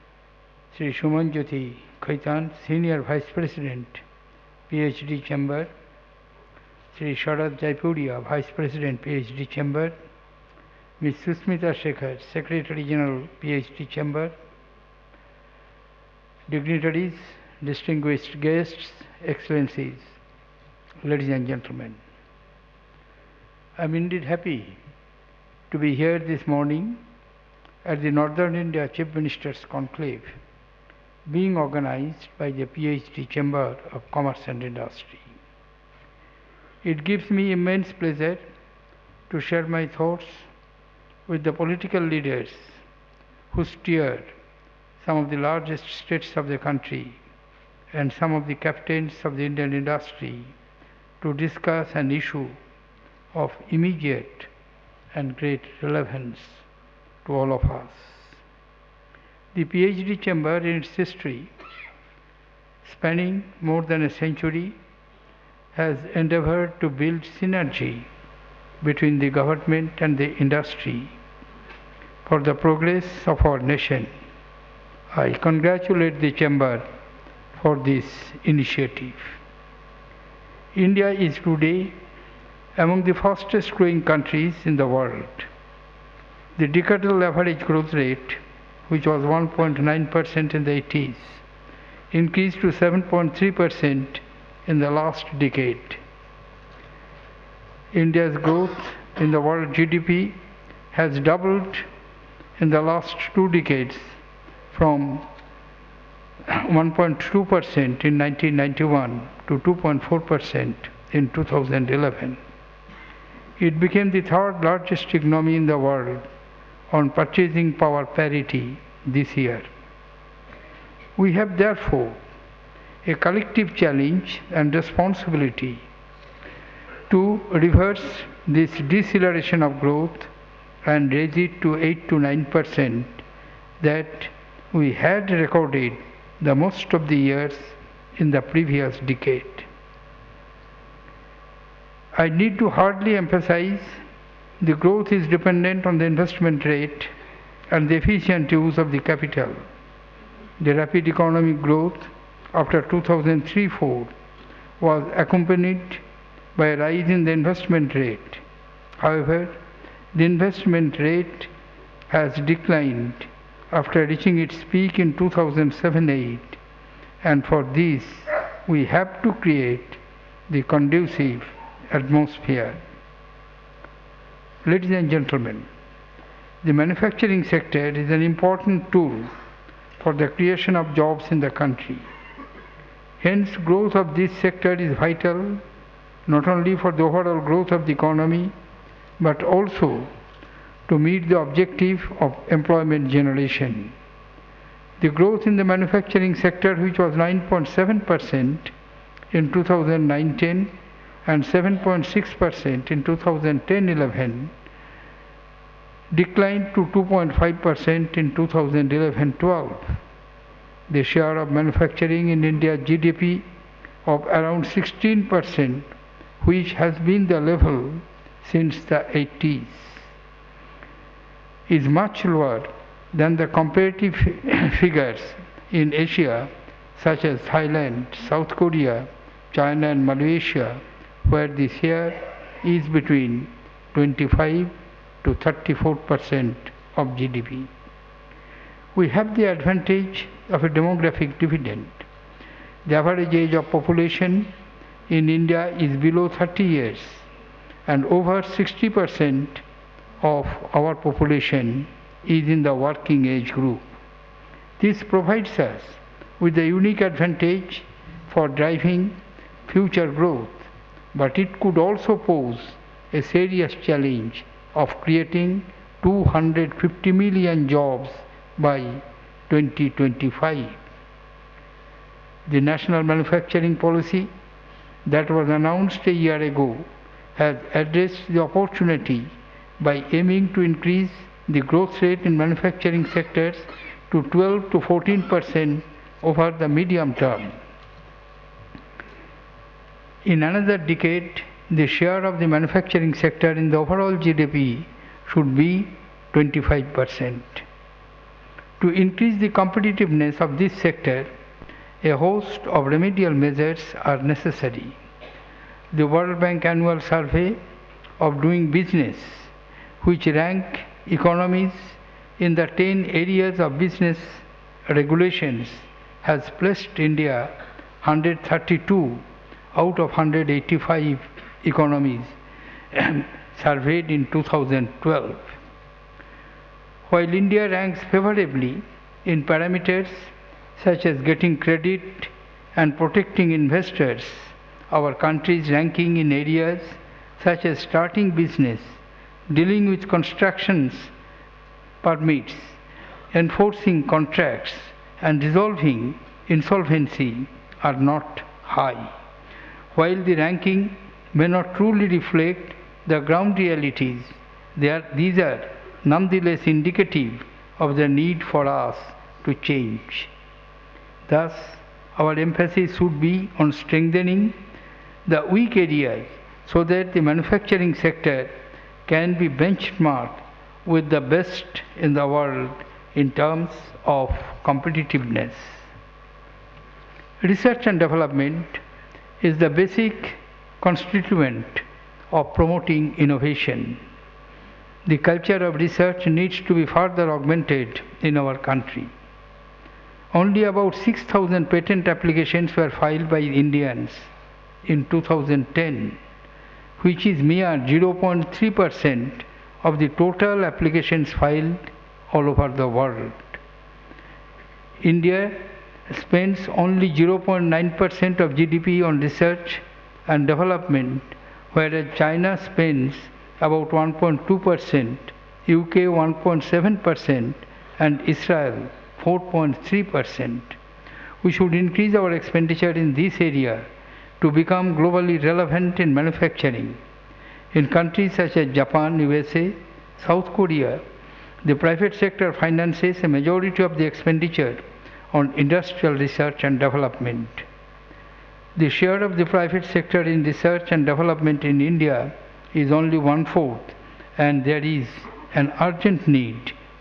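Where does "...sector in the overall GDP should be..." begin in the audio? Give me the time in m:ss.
4:53.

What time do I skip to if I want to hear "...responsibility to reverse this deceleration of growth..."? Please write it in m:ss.
2:04.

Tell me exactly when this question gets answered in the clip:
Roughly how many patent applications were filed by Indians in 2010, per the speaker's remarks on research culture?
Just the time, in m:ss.
6:30.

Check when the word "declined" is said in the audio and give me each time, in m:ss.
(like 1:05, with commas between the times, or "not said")
2:42, 3:26.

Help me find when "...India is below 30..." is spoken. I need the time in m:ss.
4:05.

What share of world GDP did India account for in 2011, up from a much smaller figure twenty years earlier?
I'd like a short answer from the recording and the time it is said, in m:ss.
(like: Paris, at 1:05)
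2.4%, at 1:49.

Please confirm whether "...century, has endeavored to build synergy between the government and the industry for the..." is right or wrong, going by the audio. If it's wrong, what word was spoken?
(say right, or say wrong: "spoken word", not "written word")
right.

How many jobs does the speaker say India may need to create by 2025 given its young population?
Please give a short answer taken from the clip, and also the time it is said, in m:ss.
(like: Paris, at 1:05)
250 million, at 4:26.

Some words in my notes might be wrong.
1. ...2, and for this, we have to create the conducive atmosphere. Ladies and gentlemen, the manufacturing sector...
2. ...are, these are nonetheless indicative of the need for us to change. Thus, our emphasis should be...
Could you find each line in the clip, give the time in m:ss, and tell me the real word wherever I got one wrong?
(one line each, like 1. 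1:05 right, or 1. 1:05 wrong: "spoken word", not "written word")
1. 2:46 wrong: "8", not "2"
2. 5:54 right.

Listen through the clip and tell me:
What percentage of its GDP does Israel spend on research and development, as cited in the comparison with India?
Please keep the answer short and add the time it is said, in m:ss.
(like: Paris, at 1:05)
4.3%, at 6:59.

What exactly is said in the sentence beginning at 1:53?
It became the third largest economy in the world on purchasing power parity this year.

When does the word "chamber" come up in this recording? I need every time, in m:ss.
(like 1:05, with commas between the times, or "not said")
0:05, 0:09, 0:13, 0:33, 1:00, 1:16.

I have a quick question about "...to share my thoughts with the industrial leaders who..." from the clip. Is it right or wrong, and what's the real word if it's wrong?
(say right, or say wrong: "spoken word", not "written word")
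wrong: "political", not "industrial".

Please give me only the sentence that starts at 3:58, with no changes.
We have the advantage of a demographic dividend.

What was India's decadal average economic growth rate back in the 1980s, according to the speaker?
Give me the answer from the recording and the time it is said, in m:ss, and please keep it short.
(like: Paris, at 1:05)
1.9%, at 1:29.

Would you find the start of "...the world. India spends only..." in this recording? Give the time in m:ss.
6:42.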